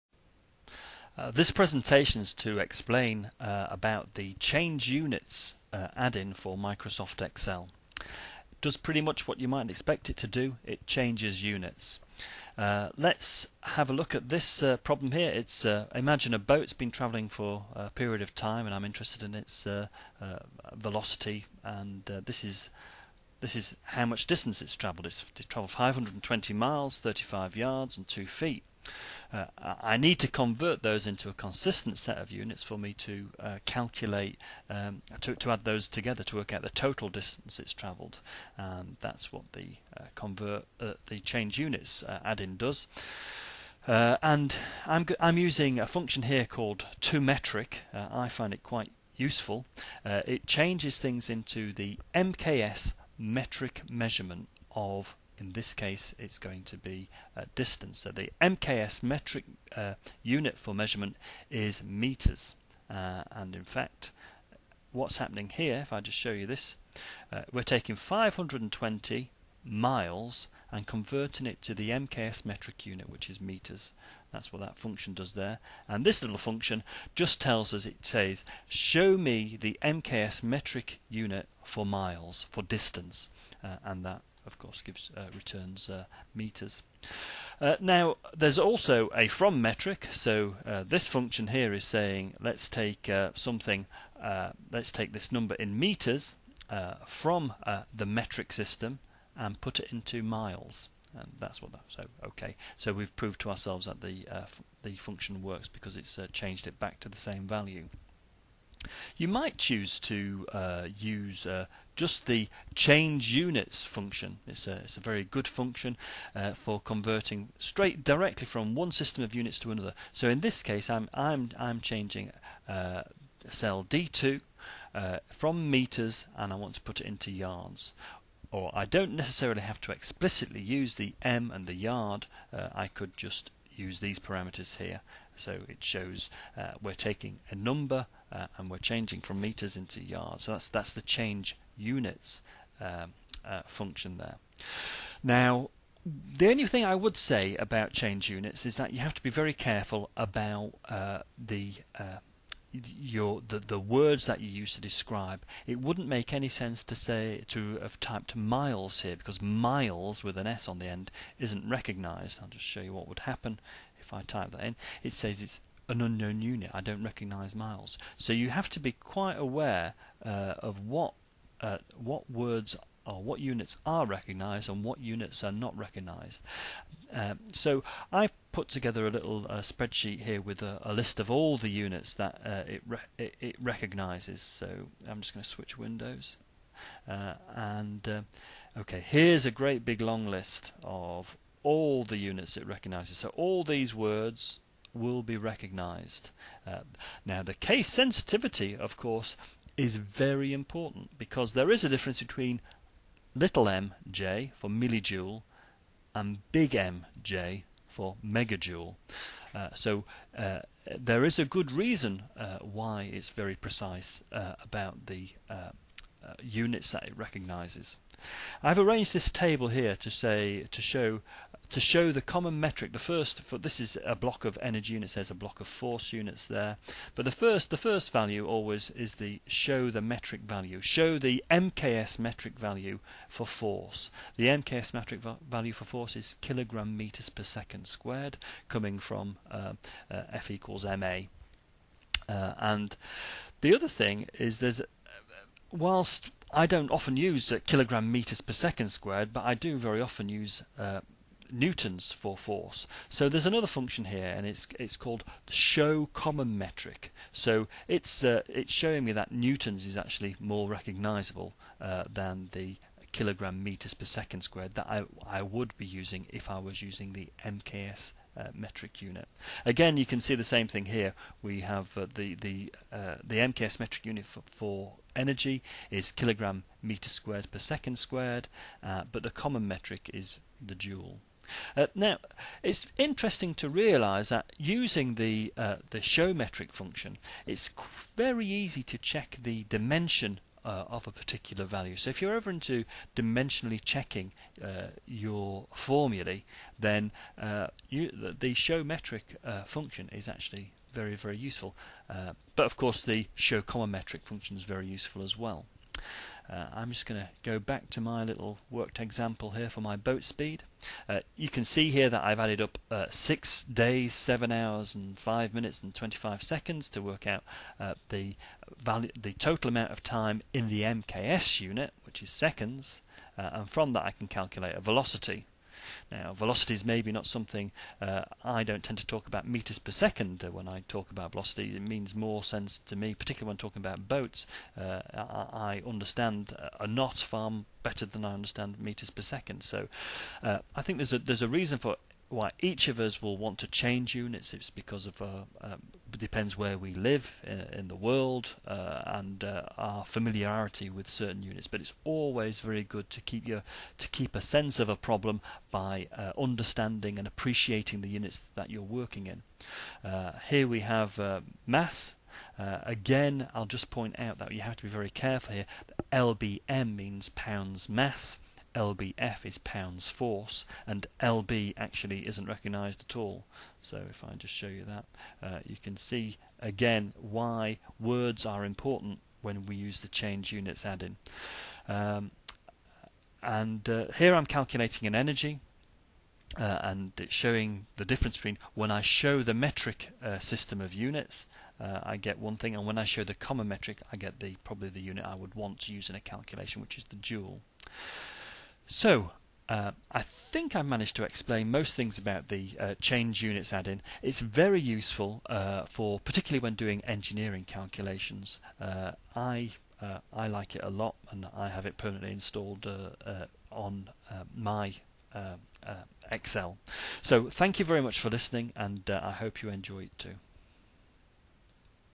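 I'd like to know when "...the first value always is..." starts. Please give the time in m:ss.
3:47.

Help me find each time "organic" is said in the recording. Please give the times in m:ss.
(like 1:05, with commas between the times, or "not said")
not said.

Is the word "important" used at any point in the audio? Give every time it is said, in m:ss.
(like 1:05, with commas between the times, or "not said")
3:20, 6:18.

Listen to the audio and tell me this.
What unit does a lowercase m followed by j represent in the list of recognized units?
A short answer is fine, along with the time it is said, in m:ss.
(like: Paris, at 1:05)
millijoule, at 3:24.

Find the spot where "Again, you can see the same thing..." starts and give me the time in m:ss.
4:29.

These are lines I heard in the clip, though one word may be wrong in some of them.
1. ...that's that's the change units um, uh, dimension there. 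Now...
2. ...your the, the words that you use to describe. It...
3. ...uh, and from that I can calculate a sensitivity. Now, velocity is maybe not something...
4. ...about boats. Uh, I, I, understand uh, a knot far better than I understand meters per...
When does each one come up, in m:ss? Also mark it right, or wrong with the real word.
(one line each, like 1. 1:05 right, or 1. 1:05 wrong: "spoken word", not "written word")
1. 2:20 wrong: "function", not "dimension"
2. 2:32 right
3. 5:23 wrong: "velocity", not "sensitivity"
4. 5:33 right.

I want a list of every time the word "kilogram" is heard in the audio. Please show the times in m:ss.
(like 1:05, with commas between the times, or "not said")
3:56, 4:07, 4:23, 4:36.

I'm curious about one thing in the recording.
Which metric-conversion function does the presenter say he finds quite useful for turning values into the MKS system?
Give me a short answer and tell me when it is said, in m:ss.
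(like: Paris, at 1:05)
toMetric, at 0:46.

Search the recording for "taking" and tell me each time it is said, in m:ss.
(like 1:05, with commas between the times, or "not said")
1:07, 2:16.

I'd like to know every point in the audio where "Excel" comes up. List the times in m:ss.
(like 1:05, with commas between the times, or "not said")
0:07, 6:56.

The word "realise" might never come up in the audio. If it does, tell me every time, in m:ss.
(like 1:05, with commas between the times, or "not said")
4:43.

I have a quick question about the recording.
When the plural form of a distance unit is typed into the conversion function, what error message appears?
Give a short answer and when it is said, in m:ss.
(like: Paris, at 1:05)
Unknown unit, at 2:46.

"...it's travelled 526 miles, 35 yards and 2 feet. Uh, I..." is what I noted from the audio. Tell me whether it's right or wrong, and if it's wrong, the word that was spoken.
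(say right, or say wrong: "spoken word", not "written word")
wrong: "520", not "526".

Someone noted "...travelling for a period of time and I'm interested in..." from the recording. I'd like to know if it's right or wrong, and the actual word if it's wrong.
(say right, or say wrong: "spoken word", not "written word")
right.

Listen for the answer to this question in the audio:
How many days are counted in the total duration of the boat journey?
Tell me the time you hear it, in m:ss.
5:13.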